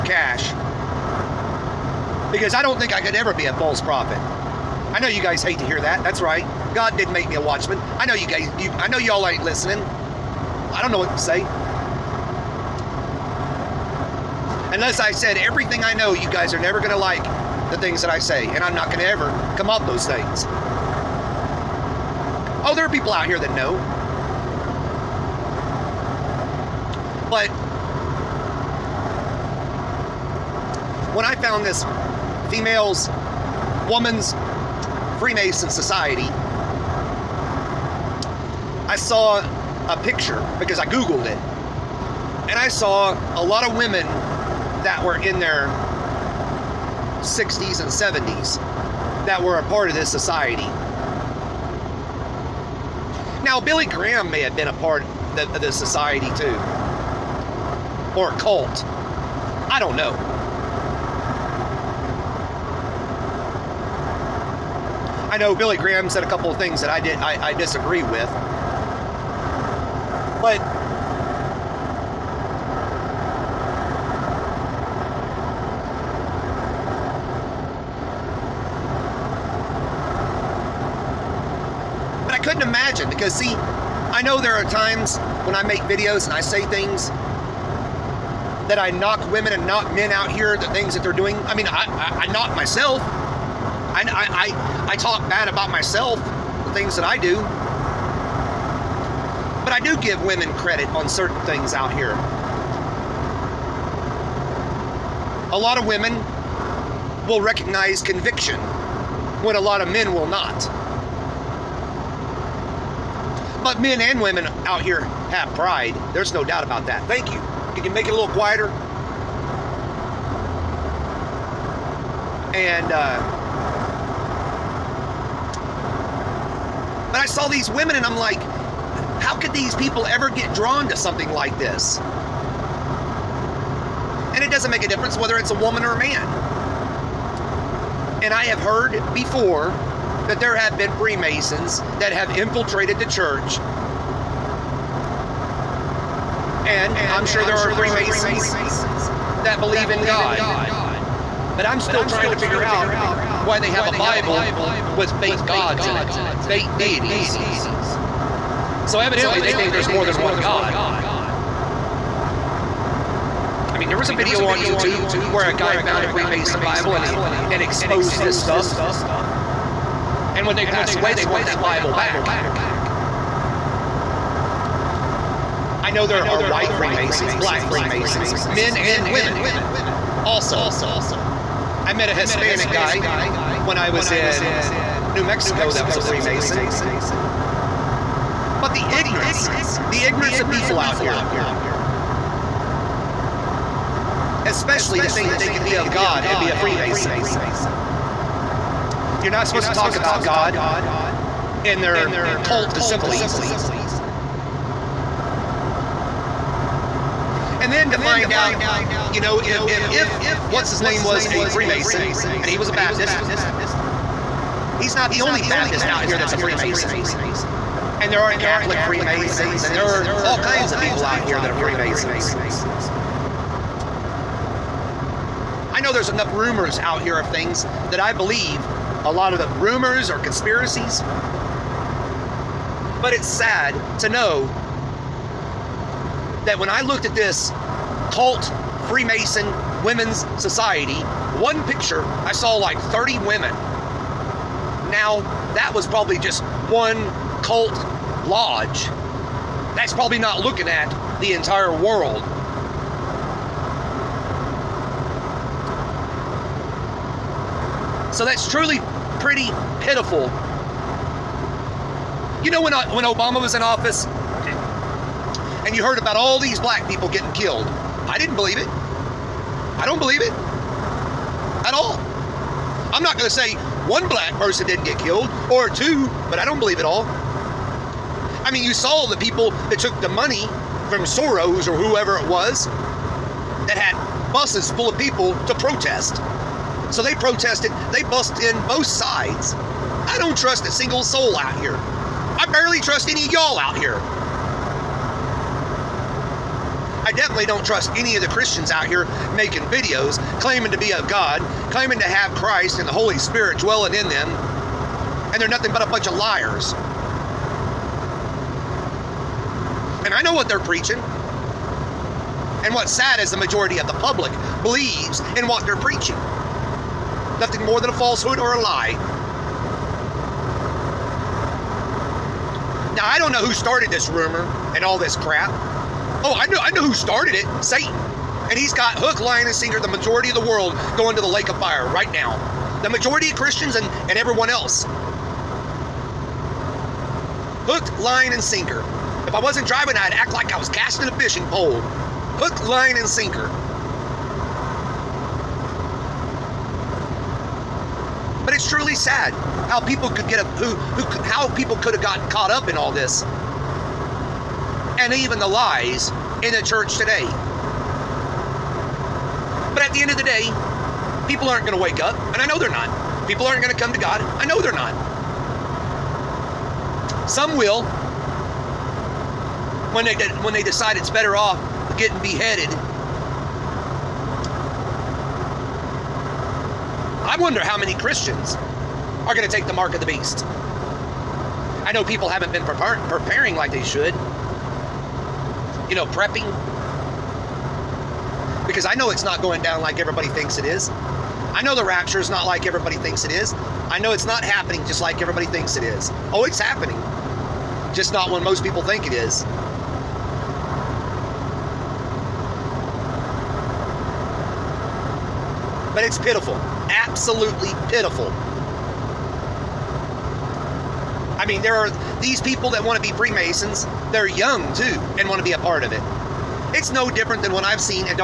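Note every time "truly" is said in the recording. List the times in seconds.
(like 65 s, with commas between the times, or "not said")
258 s, 348 s.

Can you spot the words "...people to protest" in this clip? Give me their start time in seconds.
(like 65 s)
284 s.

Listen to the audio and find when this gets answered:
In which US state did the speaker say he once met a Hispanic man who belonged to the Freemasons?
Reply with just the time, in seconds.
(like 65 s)
185 s.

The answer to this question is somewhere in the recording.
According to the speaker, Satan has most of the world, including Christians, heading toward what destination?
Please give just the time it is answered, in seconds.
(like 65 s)
331 s.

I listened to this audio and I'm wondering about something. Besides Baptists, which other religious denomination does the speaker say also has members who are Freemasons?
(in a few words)
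Catholic.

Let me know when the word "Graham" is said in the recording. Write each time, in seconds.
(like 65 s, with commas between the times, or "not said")
53 s, 65 s.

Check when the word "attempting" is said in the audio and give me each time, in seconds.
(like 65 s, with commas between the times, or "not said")
not said.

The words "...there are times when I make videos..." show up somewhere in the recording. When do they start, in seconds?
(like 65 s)
84 s.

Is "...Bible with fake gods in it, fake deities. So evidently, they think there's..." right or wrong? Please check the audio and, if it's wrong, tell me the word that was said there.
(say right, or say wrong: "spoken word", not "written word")
right.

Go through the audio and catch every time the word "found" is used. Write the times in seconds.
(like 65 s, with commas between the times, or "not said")
31 s, 165 s.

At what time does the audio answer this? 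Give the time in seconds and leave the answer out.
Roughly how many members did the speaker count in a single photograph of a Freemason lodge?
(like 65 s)
242 s.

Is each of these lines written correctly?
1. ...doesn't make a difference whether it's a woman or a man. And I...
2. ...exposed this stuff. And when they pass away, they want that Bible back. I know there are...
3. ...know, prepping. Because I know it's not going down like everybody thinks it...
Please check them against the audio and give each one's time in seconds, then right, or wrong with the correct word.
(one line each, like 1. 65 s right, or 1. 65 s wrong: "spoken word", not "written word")
1. 134 s right
2. 167 s right
3. 385 s right.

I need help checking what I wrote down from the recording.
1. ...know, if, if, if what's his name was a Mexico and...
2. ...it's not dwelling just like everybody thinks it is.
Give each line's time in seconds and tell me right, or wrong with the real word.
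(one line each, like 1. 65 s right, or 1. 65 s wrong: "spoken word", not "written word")
1. 209 s wrong: "Freemason", not "Mexico"
2. 394 s wrong: "happening", not "dwelling".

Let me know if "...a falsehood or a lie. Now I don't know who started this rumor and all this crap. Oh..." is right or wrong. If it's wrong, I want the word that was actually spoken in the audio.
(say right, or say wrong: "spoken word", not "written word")
right.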